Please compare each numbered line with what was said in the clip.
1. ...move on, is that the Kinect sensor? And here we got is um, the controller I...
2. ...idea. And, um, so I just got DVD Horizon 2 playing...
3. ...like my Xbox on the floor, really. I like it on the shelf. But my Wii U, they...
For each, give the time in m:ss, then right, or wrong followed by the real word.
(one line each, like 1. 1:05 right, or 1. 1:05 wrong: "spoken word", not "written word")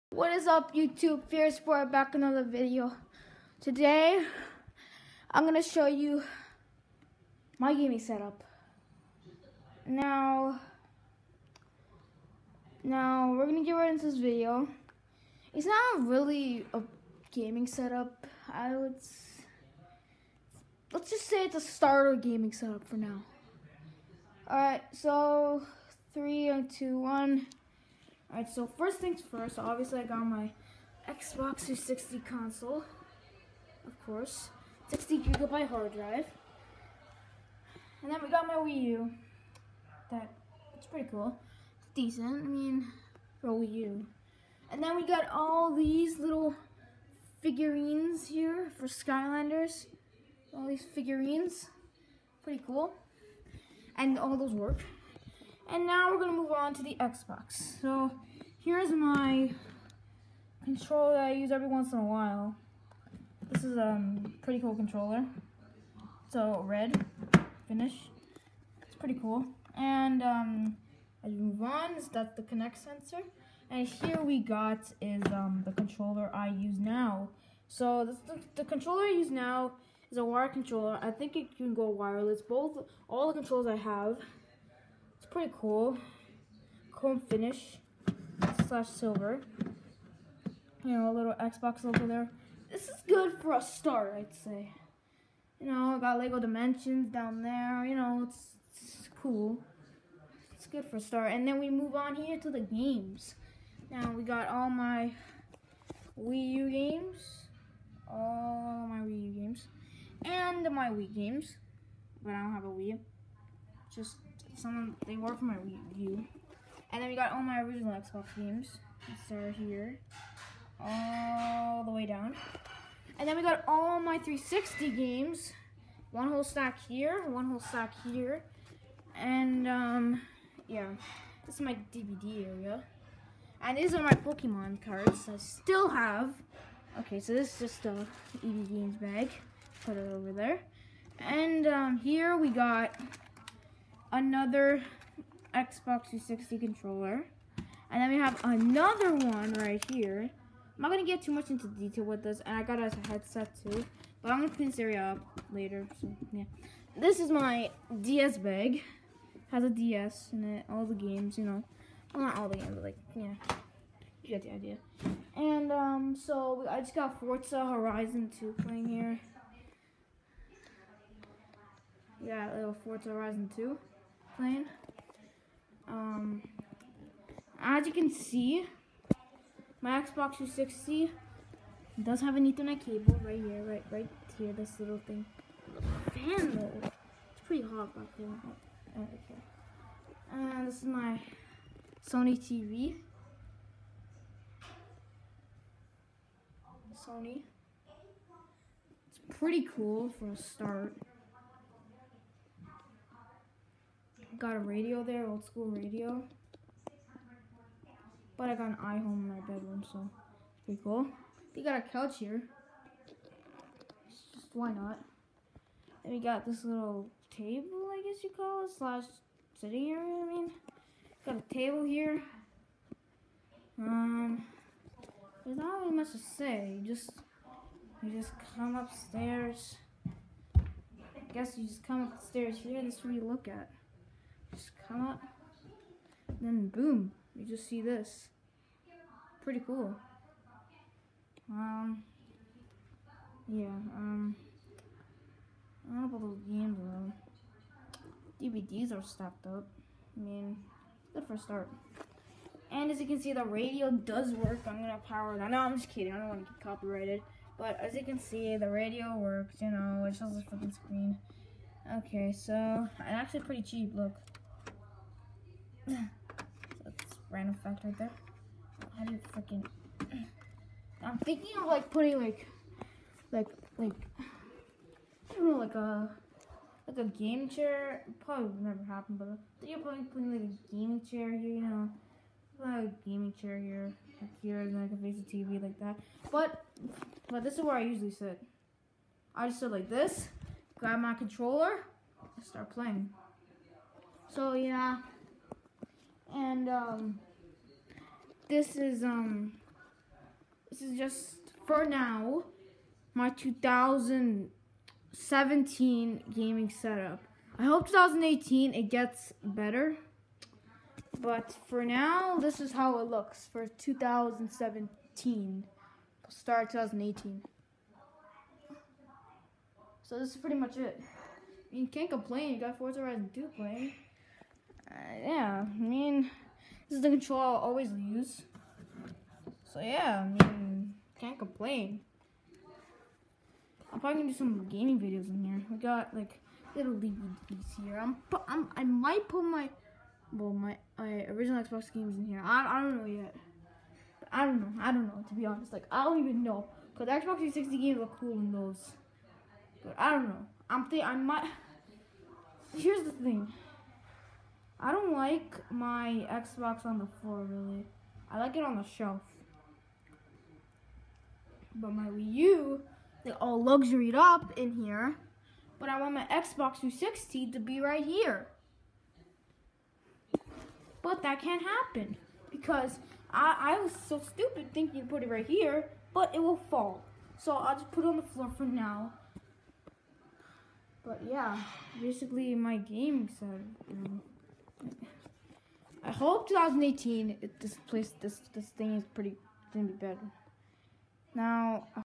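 1. 1:11 right
2. 2:44 wrong: "Forza", not "DVD"
3. 5:55 right.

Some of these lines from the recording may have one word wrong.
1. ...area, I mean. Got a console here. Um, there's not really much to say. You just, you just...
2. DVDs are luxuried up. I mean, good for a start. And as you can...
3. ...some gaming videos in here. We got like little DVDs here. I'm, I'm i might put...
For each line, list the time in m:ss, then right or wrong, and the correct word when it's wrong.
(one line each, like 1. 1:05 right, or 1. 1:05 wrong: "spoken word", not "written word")
1. 3:39 wrong: "table", not "console"
2. 4:08 wrong: "stacked", not "luxuried"
3. 5:34 right.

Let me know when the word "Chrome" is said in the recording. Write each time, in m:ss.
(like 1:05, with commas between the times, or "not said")
1:26.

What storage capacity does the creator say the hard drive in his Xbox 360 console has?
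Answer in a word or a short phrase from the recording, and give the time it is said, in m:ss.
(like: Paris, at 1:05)
60 gigabyte, at 0:34.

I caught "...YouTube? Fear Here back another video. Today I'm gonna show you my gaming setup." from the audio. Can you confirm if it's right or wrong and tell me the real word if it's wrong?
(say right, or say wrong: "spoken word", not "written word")
wrong: "Sport", not "Here".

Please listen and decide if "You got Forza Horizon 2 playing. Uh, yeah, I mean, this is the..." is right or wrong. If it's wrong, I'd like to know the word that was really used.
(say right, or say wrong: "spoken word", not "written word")
right.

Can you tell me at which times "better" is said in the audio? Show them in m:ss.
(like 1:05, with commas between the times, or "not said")
5:09, 6:29.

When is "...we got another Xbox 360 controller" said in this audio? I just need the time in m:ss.
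2:22.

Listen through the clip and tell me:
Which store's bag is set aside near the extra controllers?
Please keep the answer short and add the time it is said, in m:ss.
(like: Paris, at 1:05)
EB Games, at 2:18.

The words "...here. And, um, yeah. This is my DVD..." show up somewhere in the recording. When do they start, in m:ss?
2:08.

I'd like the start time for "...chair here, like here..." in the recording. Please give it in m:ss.
4:43.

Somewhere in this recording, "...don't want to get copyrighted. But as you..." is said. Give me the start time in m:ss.
4:16.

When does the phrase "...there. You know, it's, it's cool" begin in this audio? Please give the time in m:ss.
1:37.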